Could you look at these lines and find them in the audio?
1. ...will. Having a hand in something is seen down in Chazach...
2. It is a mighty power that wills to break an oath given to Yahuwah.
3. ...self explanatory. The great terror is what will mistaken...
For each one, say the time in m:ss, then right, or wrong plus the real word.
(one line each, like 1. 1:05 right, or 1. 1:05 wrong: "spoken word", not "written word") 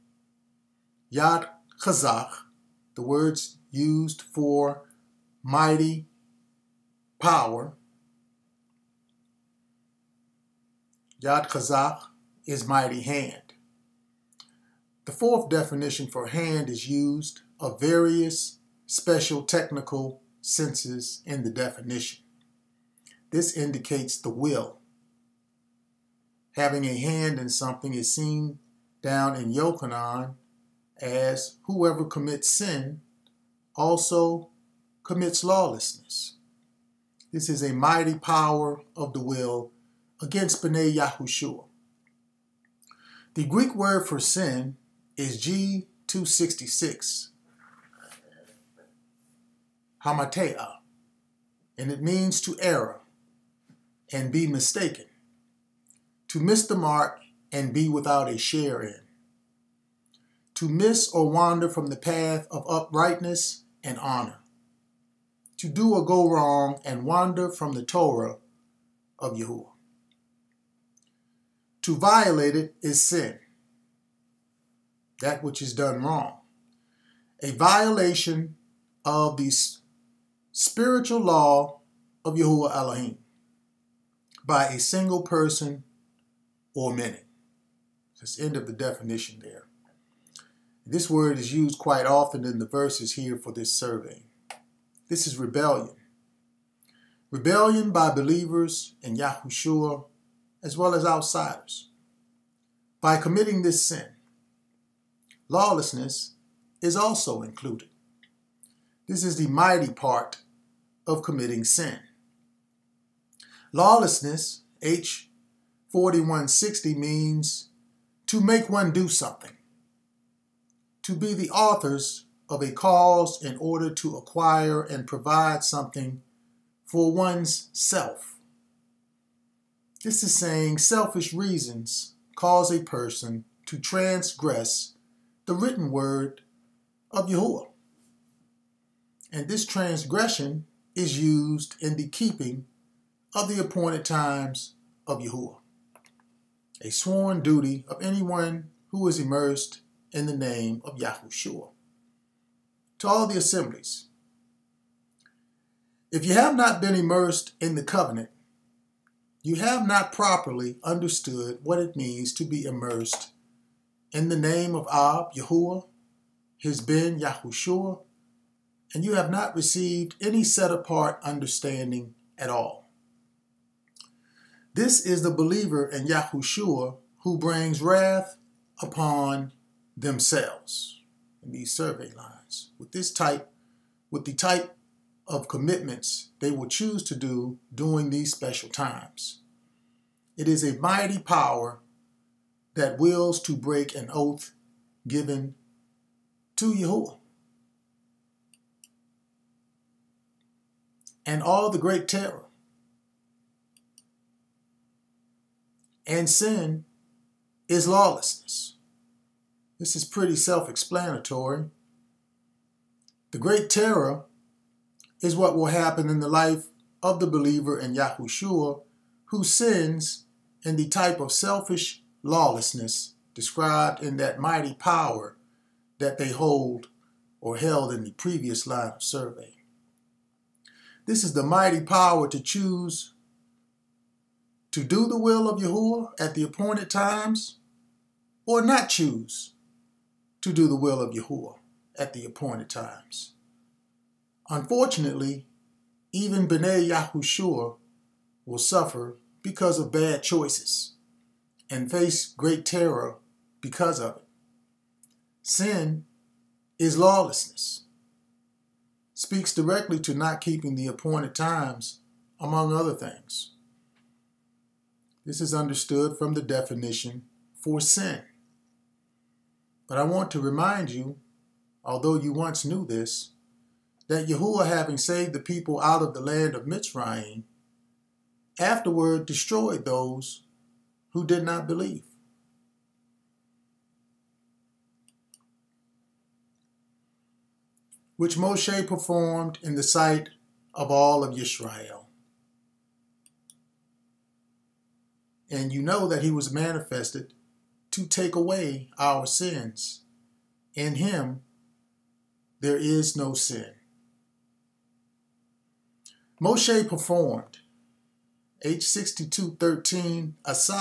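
1. 0:24 wrong: "Yochanan", not "Chazach"
2. 3:10 right
3. 3:30 wrong: "happen", not "mistaken".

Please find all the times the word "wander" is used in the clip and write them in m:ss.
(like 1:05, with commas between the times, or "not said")
1:01, 1:07.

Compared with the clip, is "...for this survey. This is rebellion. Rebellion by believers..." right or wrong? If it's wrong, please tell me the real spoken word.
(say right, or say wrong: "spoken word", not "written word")
right.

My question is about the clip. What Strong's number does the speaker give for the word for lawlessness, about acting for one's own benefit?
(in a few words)
H4160.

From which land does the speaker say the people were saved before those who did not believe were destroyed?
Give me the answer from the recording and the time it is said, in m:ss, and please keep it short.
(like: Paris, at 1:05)
Mitzrayim, at 4:36.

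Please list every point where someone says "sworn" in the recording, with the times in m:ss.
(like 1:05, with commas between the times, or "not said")
2:26.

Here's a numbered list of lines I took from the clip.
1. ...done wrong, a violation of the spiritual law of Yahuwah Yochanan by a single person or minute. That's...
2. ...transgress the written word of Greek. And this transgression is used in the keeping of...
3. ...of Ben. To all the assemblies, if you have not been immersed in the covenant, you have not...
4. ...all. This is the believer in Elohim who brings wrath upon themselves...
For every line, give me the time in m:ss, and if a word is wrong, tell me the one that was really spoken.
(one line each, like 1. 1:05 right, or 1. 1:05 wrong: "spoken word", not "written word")
1. 1:15 wrong: "Elohim", not "Yochanan"
2. 2:13 wrong: "Yahuwah", not "Greek"
3. 2:30 wrong: "Yahushua", not "Ben"
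4. 2:52 wrong: "Yahushua", not "Elohim".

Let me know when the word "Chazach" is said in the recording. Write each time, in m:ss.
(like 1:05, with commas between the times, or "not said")
0:01, 0:11.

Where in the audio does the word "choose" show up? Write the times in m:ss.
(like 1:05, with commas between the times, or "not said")
3:06, 3:52, 3:58.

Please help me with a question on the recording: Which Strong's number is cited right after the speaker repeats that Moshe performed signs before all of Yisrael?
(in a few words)
H6213.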